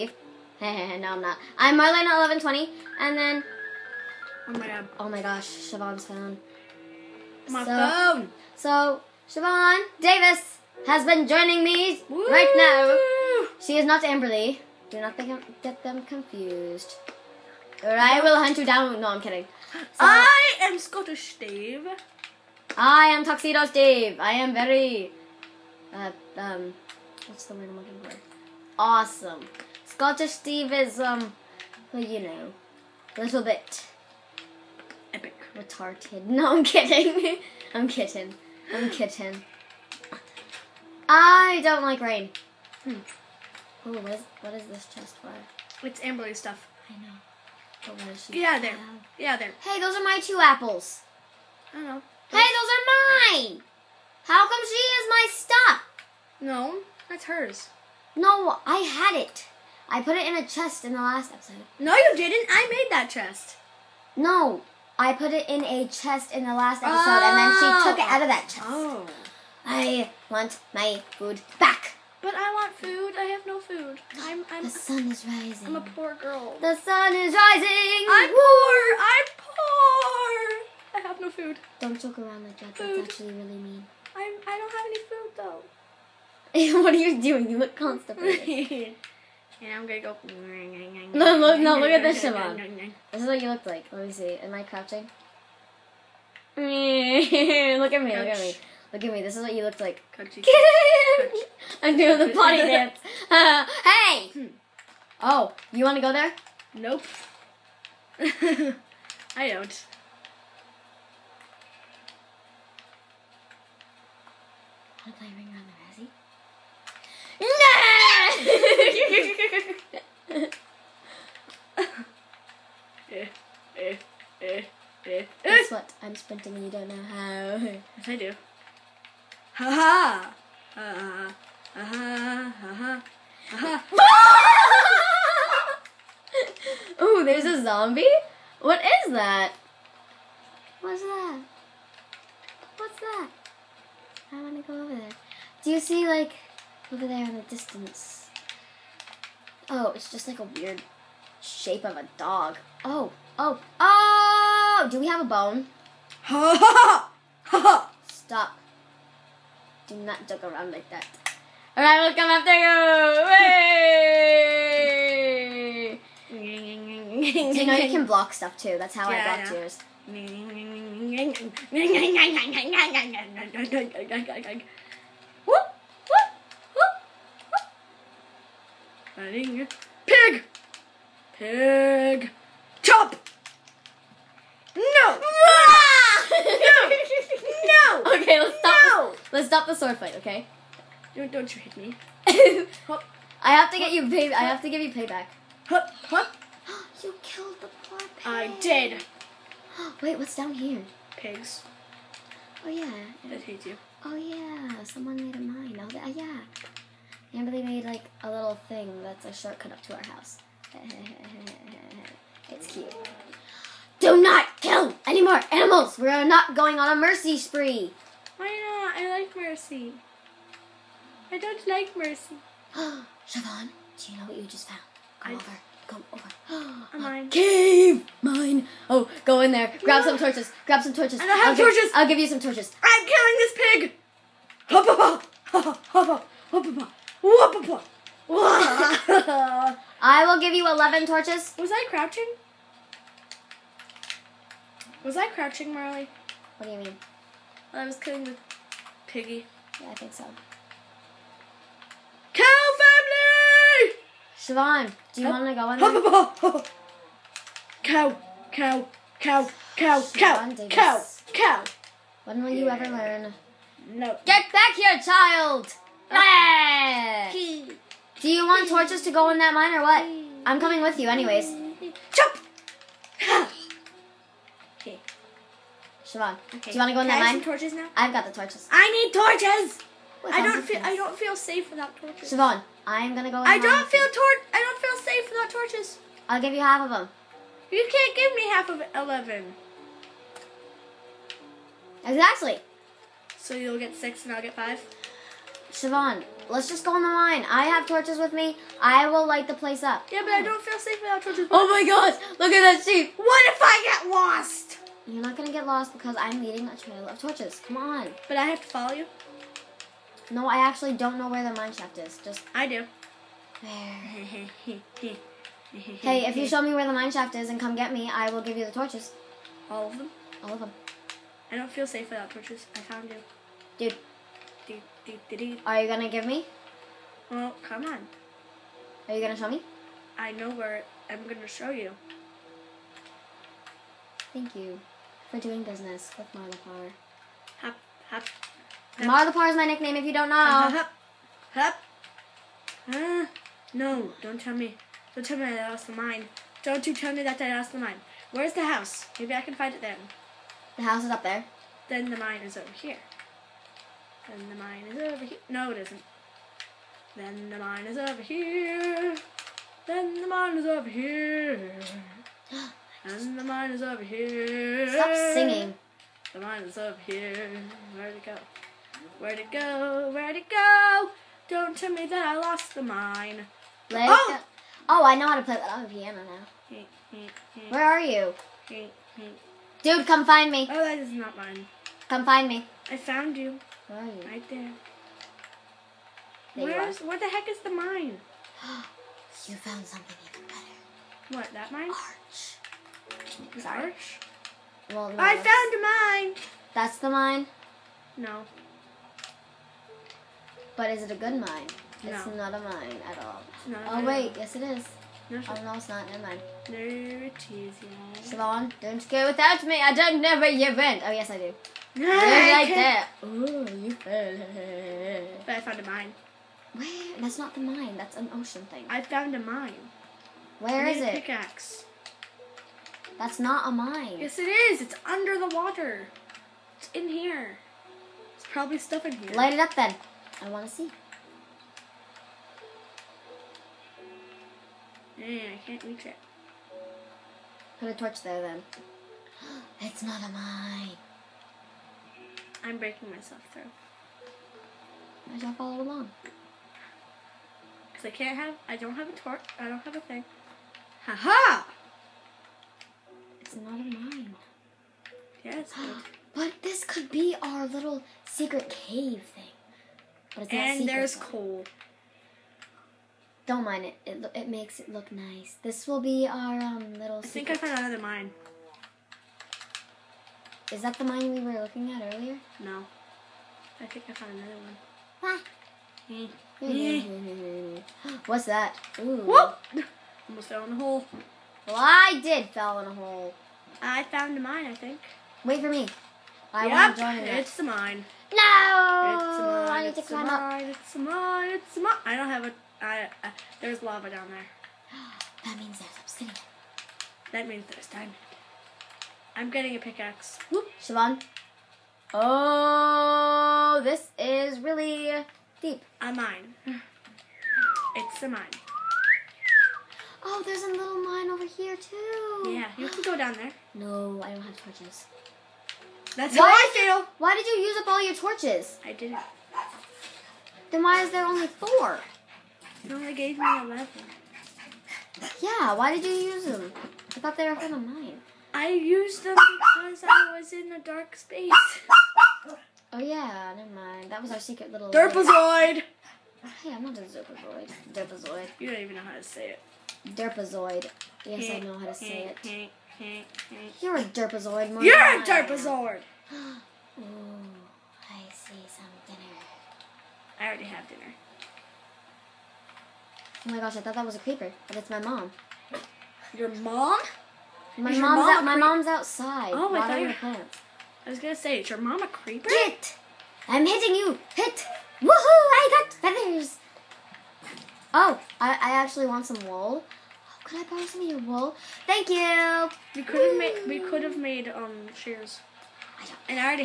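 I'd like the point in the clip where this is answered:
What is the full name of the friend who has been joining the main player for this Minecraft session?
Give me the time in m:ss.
0:09.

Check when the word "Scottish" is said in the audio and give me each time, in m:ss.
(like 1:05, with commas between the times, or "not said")
0:20, 0:29.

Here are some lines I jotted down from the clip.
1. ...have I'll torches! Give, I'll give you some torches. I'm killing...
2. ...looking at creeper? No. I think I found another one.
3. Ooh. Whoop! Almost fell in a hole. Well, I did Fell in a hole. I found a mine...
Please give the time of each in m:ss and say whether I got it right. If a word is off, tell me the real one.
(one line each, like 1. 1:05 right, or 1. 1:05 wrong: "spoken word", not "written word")
1. 3:51 right
2. 7:51 wrong: "earlier", not "creeper"
3. 7:58 right.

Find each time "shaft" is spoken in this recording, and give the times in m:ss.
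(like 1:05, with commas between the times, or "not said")
5:11, 5:17.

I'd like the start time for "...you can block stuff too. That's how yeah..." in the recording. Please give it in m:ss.
2:47.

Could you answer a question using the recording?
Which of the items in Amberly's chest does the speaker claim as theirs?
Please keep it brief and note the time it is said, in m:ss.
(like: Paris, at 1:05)
two apples, at 0:50.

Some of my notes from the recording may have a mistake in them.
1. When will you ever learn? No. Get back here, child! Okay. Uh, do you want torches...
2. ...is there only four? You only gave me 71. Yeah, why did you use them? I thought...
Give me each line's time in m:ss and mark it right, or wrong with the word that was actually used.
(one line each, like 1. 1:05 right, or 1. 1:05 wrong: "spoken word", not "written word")
1. 4:22 right
2. 8:41 wrong: "11", not "71".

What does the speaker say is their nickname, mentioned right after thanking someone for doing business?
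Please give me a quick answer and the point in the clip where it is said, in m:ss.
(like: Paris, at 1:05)
Marlapar, at 5:38.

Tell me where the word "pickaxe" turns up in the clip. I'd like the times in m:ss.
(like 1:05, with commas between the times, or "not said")
7:01, 8:19.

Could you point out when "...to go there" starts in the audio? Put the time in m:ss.
1:45.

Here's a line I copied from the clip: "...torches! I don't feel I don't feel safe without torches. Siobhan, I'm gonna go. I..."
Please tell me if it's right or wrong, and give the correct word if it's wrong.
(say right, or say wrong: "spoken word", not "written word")
right.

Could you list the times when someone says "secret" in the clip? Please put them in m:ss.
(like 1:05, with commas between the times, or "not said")
7:38, 8:54.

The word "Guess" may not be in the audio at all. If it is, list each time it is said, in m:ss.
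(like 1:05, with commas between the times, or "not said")
2:05.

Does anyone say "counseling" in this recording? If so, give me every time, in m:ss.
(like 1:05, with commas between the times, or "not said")
not said.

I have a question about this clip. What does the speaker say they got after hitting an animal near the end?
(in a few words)
feathers.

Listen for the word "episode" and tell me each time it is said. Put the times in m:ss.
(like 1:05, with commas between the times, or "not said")
1:01, 1:06.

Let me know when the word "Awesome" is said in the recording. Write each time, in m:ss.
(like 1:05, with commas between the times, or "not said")
0:28.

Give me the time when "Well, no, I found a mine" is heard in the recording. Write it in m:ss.
6:34.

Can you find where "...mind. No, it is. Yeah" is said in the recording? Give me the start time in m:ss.
6:46.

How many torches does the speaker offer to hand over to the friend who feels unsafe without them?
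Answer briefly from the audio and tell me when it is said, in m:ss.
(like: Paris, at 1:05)
11, at 4:00.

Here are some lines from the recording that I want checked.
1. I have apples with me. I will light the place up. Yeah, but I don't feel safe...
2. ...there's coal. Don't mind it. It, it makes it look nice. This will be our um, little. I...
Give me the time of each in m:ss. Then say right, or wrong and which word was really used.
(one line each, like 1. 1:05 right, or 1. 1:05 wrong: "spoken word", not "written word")
1. 4:57 wrong: "torches", not "apples"
2. 7:40 right.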